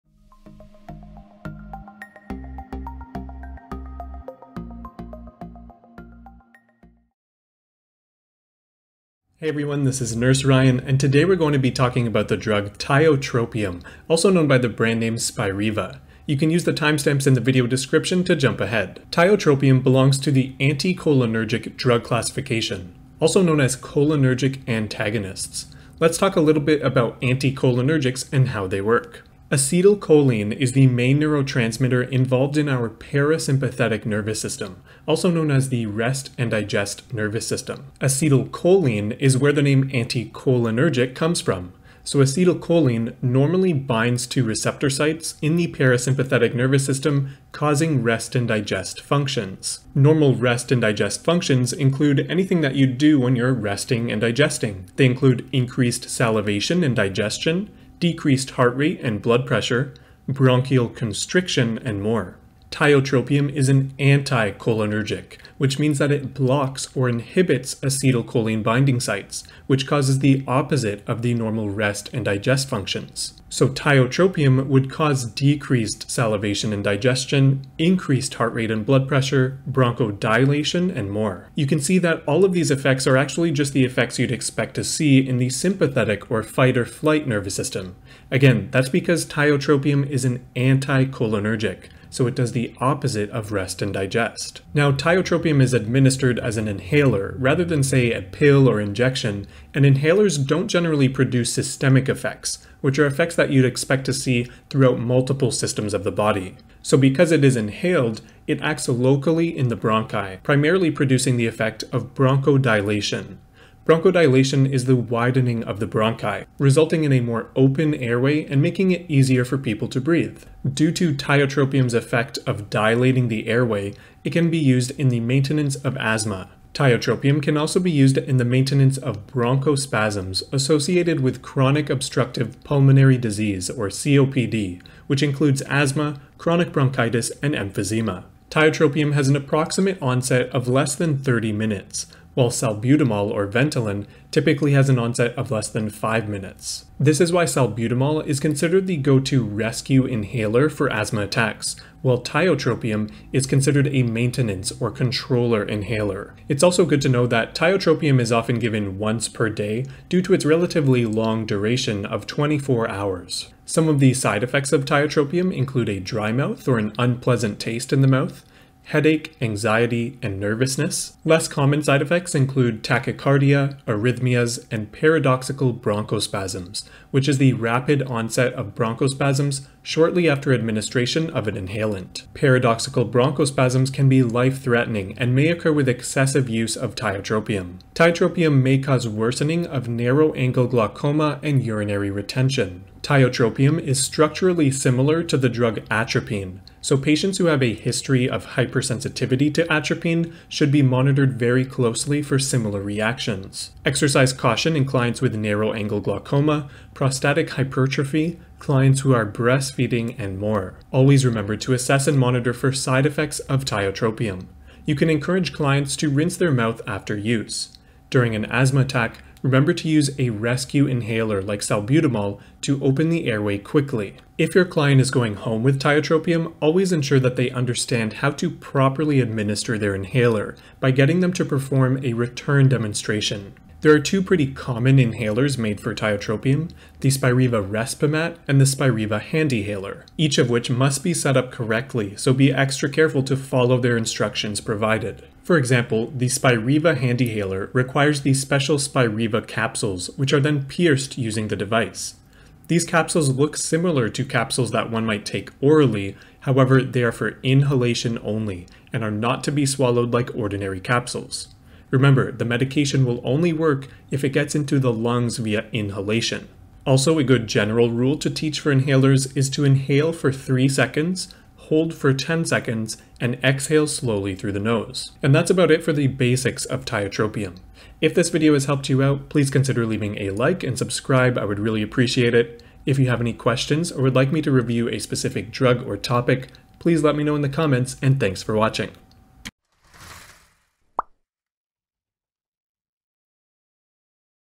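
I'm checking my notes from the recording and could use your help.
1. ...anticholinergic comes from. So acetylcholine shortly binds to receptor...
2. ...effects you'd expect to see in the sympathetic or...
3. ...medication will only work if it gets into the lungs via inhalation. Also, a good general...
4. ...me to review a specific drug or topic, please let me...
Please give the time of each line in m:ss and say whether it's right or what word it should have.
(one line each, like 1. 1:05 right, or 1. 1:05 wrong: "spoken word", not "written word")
1. 0:39 wrong: "normally", not "shortly"
2. 1:23 right
3. 4:22 right
4. 4:44 right.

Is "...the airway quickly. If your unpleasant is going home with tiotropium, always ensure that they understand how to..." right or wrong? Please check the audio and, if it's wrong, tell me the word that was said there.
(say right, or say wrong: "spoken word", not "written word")
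wrong: "client", not "unpleasant".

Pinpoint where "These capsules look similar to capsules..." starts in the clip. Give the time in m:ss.
4:12.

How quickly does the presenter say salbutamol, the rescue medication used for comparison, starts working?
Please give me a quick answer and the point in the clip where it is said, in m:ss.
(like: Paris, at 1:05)
less than 5 minutes, at 2:25.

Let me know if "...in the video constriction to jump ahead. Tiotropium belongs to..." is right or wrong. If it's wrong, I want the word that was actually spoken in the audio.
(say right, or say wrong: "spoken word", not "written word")
wrong: "description", not "constriction".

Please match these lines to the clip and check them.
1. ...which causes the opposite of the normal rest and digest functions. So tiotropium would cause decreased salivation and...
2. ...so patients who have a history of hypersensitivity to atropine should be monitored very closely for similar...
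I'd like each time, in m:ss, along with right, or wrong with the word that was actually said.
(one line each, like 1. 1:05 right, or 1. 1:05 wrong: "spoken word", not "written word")
1. 1:09 right
2. 3:16 right.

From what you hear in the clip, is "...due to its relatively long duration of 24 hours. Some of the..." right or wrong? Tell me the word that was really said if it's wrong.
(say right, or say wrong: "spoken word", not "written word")
right.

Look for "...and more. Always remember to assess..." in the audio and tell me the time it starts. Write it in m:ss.
3:30.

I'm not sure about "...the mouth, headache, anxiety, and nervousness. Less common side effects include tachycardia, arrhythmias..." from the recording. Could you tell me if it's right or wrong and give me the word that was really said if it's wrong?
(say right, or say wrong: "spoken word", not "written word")
right.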